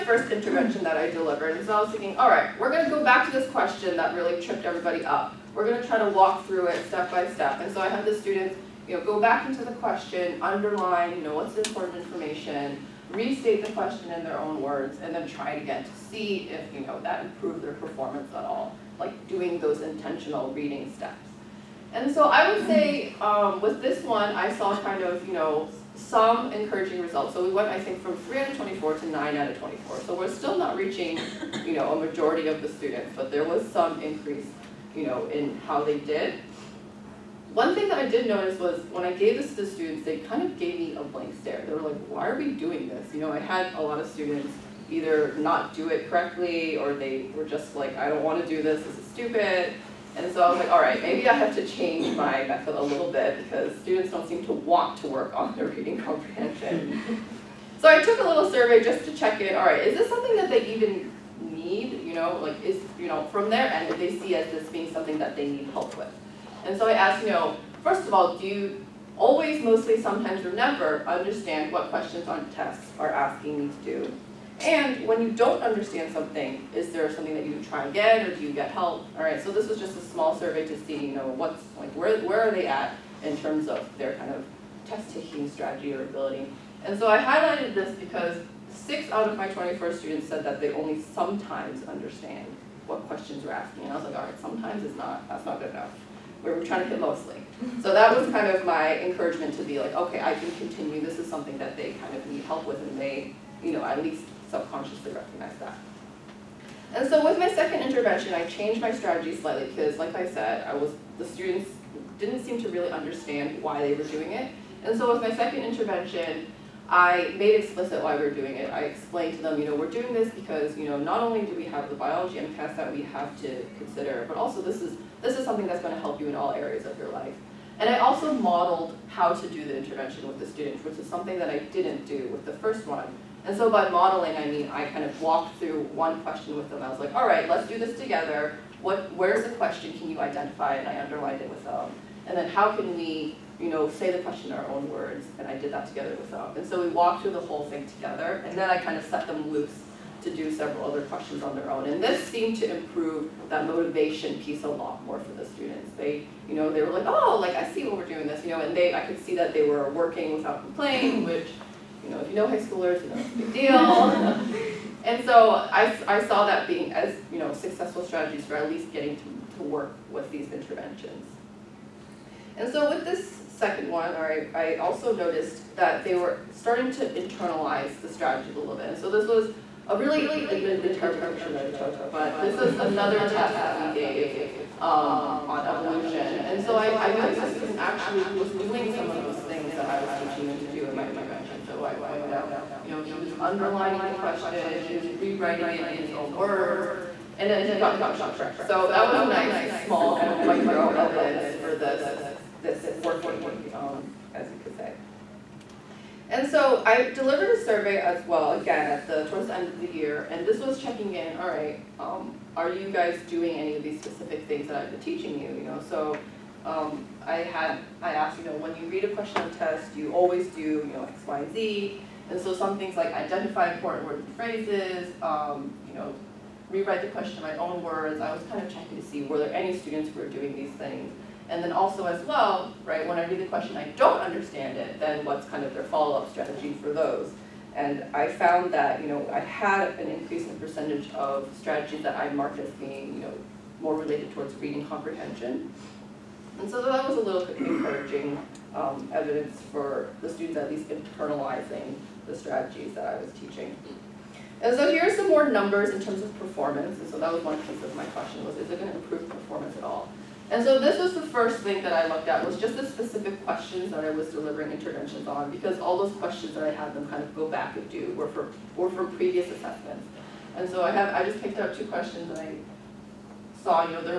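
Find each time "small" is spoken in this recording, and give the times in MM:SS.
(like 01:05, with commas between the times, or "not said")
01:20, 03:19.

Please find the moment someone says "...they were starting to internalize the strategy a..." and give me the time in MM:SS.
02:56.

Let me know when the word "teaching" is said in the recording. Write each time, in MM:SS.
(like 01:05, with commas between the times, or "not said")
03:10, 03:34, 04:13.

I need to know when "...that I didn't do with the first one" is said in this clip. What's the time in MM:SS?
02:11.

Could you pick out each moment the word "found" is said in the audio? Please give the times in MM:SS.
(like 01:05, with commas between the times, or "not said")
03:58.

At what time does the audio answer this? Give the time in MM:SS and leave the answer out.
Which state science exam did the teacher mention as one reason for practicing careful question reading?
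02:01.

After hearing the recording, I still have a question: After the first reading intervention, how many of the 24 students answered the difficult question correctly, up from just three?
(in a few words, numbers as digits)
9.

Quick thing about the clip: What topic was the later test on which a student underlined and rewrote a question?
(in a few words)
evolution.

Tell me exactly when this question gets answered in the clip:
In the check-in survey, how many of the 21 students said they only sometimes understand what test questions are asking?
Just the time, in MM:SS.
01:28.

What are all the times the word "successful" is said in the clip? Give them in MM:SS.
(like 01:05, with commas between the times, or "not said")
02:47.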